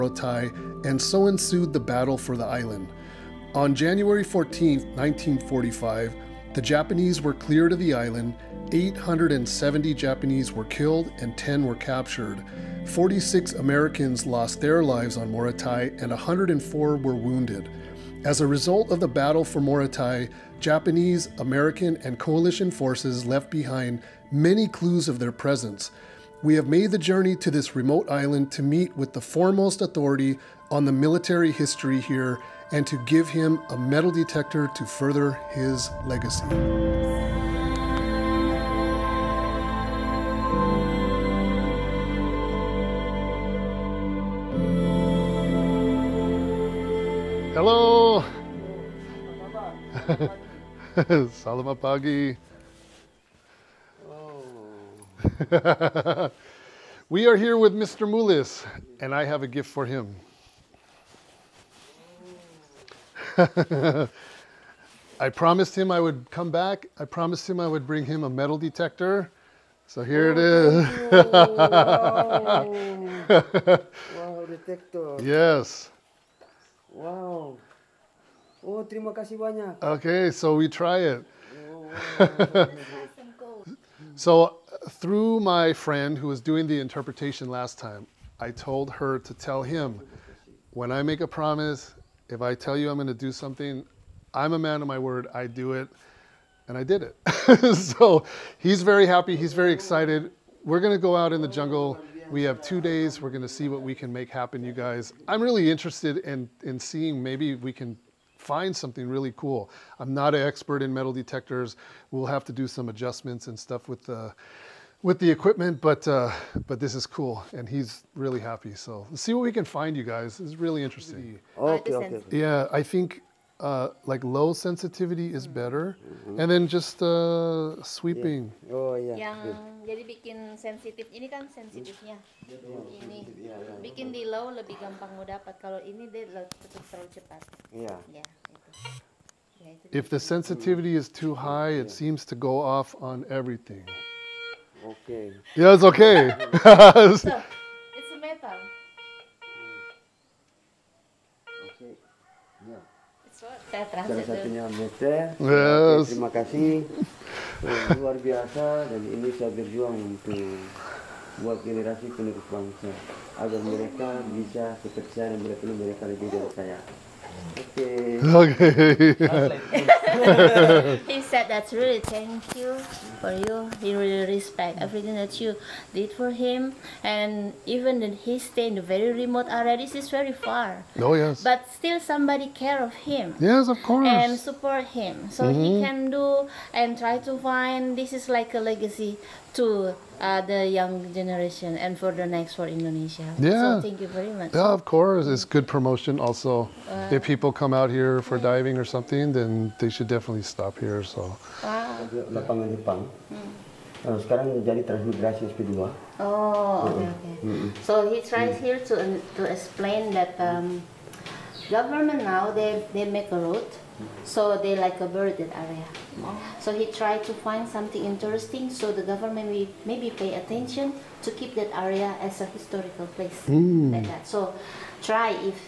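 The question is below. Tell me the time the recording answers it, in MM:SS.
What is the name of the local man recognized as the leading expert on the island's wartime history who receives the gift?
00:57.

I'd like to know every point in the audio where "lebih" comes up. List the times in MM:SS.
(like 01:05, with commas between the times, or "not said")
02:14, 02:46.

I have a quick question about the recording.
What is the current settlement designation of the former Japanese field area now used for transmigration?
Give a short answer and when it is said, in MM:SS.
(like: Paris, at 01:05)
SP2, at 03:25.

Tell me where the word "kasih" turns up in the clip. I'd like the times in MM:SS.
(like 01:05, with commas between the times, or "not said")
01:19, 02:36.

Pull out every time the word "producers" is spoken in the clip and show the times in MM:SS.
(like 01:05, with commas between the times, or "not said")
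not said.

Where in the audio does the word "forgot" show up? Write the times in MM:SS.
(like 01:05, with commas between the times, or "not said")
not said.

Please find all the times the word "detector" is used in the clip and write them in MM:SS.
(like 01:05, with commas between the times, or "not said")
00:34, 01:08, 01:14, 01:51.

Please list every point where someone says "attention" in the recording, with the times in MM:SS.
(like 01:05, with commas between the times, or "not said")
03:40.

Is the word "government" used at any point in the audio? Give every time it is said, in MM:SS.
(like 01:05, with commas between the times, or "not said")
03:31, 03:39.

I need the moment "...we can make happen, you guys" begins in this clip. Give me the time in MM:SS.
01:43.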